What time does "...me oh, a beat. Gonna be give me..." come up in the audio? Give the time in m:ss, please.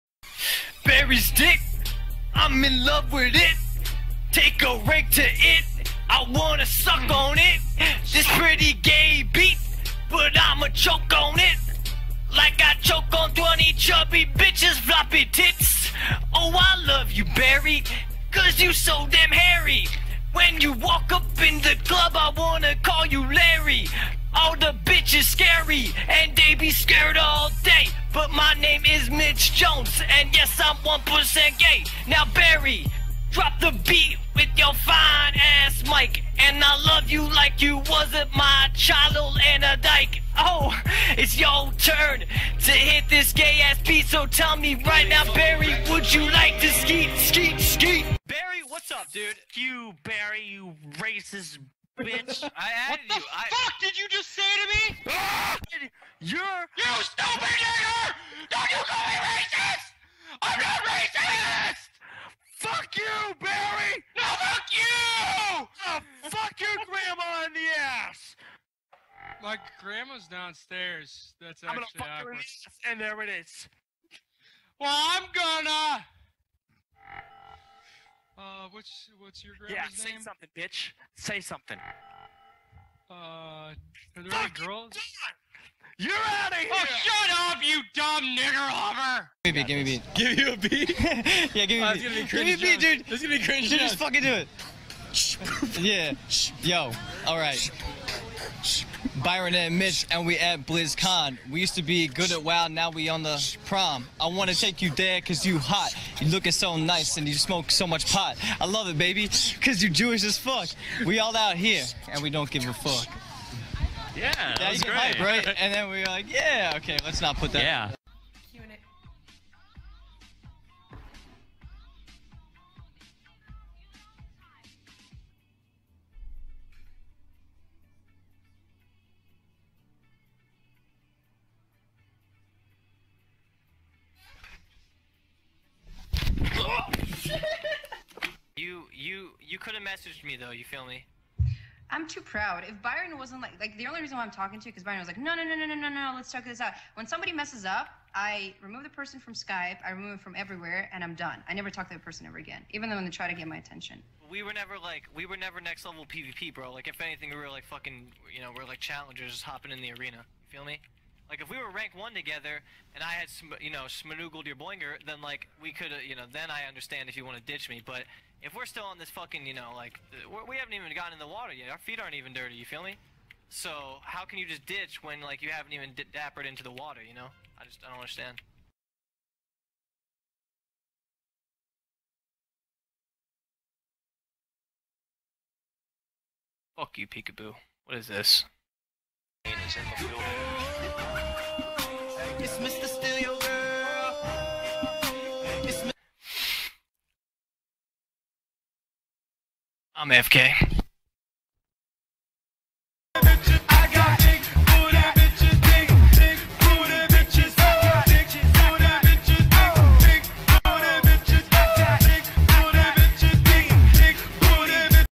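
1:31.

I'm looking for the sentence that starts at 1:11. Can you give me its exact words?
That's I'm actually I'm gonna fuck awkward.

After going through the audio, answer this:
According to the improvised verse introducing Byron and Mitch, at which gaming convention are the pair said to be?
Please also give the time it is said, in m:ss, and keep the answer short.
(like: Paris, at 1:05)
BlizzCon, at 1:40.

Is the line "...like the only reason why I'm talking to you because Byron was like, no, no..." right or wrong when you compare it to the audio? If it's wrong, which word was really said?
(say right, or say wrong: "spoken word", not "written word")
right.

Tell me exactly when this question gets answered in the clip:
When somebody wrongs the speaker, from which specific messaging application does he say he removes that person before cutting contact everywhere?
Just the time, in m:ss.
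2:29.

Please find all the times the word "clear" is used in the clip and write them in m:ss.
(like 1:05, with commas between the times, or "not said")
not said.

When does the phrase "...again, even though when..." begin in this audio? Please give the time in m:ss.
2:32.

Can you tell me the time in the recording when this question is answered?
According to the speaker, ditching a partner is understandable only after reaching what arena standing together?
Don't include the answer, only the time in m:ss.
2:41.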